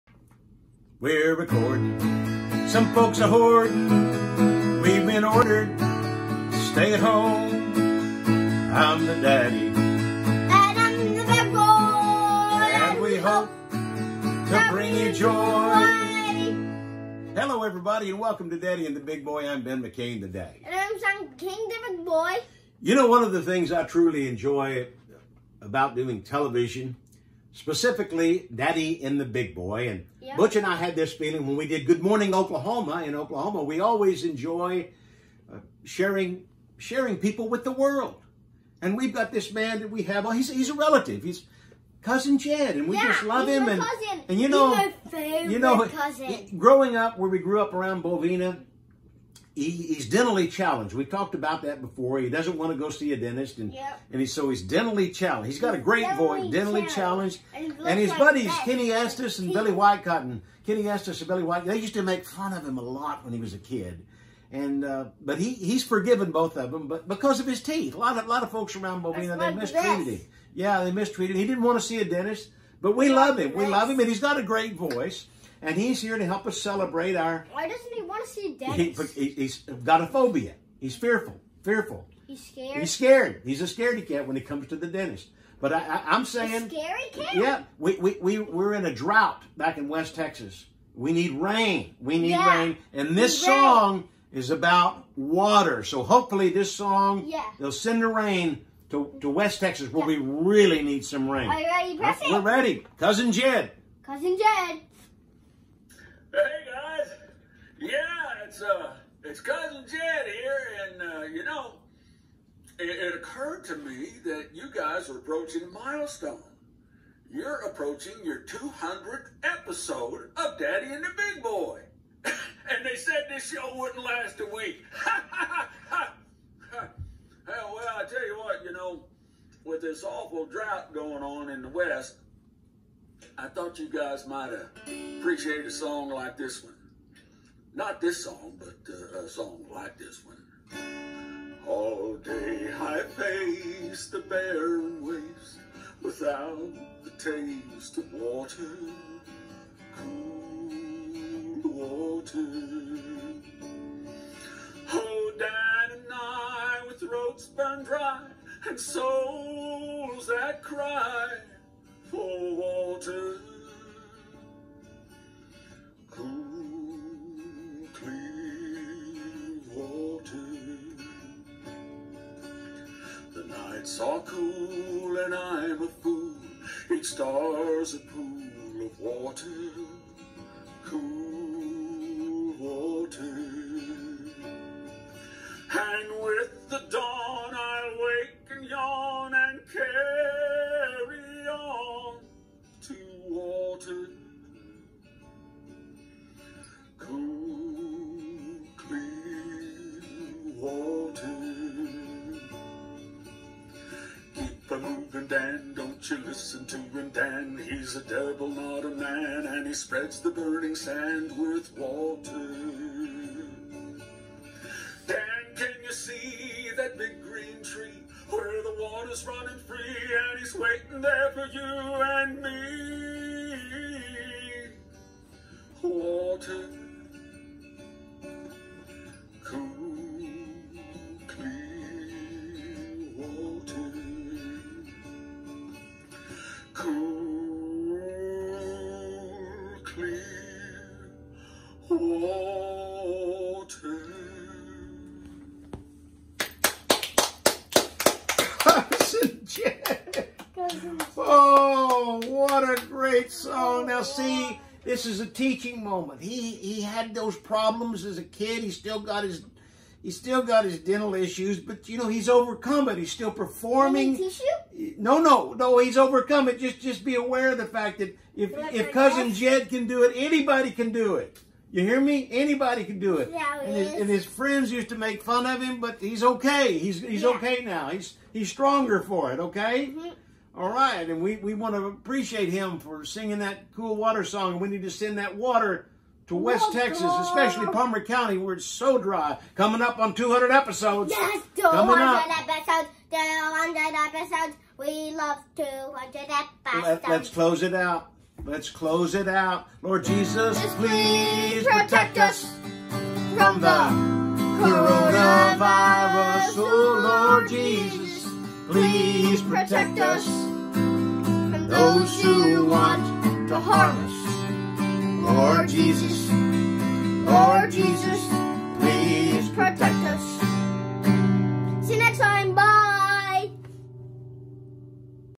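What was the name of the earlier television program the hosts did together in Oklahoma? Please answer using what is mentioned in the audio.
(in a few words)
Good Morning Oklahoma.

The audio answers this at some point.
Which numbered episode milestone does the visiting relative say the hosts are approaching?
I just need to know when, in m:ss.
1:58.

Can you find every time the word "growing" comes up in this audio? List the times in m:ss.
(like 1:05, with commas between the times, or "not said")
0:46.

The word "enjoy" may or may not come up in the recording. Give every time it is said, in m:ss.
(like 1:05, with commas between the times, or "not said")
0:24, 0:34.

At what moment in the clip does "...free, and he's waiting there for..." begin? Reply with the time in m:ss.
3:39.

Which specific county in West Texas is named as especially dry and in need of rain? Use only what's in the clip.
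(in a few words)
Parmer County.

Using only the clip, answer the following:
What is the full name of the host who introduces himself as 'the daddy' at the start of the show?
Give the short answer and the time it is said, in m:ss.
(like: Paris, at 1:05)
Ben McCain, at 0:19.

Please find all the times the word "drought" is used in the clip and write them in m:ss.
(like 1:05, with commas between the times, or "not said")
1:28, 2:10.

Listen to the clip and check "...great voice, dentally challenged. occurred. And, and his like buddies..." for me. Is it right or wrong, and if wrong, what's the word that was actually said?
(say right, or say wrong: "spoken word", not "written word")
wrong: "challenged", not "occurred".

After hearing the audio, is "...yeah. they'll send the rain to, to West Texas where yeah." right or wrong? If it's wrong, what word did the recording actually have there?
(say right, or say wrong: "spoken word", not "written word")
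right.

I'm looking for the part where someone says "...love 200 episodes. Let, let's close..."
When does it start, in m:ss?
4:55.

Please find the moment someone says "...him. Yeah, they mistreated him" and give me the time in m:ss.
1:10.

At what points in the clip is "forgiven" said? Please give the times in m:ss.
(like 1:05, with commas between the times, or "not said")
1:05.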